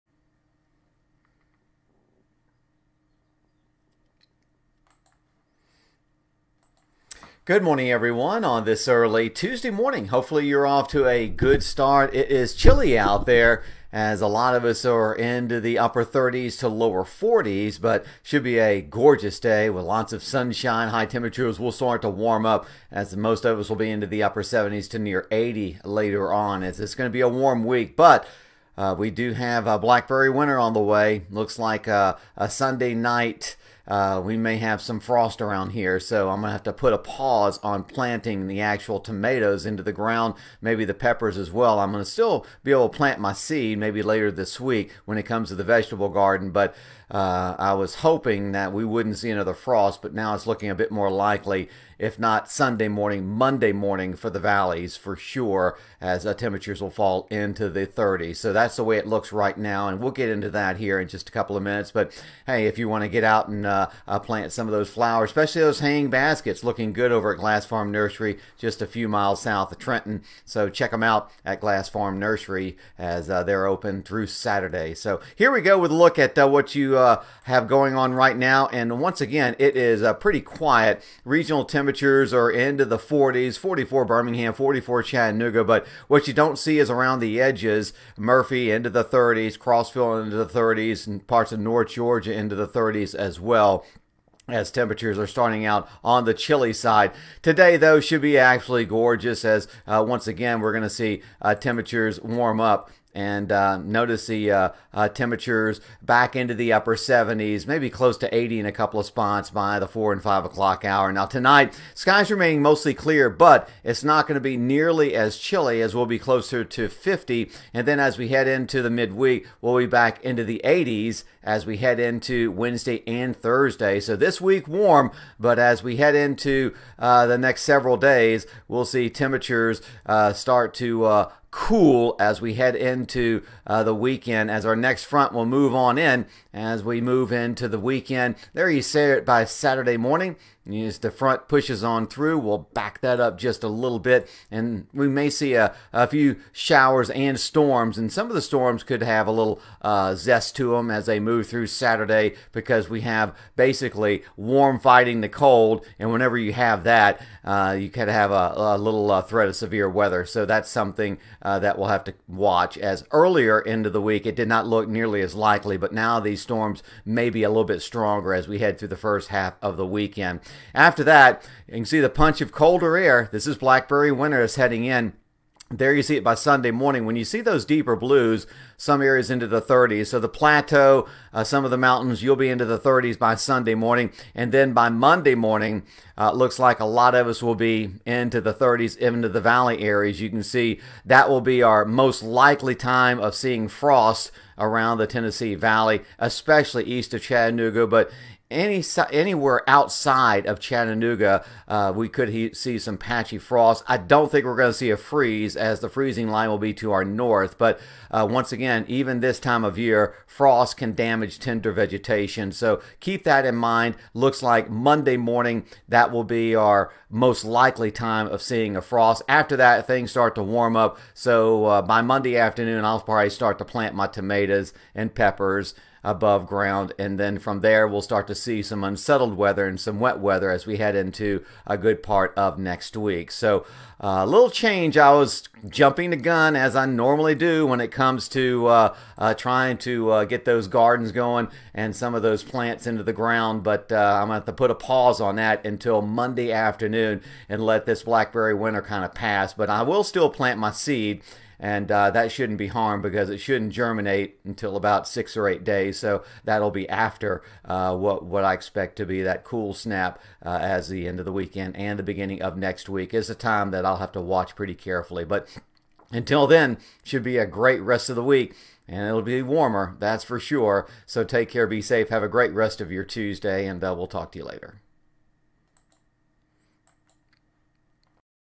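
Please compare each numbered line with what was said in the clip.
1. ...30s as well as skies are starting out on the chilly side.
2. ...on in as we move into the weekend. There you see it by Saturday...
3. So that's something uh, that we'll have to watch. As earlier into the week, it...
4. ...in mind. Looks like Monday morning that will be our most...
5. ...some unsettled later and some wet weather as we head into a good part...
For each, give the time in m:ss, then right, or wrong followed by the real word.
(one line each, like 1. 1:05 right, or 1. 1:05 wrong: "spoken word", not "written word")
1. 1:32 wrong: "temperatures", not "skies"
2. 2:15 right
3. 2:40 right
4. 3:33 right
5. 3:48 wrong: "weather", not "later".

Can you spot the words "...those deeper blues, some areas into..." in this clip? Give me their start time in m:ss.
2:57.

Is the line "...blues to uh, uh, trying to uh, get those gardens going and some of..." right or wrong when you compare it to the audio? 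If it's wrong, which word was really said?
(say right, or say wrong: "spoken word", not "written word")
wrong: "comes", not "blues".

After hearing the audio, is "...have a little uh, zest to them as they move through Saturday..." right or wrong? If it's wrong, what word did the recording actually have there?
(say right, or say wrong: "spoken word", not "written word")
right.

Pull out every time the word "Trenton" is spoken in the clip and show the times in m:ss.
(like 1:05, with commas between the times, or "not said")
1:09.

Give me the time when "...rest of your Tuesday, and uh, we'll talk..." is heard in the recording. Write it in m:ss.
4:32.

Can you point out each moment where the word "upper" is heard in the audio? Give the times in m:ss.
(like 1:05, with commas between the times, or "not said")
0:15, 0:24, 1:46.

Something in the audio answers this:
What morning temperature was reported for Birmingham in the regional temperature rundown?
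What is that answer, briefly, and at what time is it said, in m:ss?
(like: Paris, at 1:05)
44, at 1:23.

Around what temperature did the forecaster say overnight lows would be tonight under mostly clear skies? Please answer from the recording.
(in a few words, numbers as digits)
50.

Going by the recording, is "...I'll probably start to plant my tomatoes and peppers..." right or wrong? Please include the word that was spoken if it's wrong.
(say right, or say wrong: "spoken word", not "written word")
right.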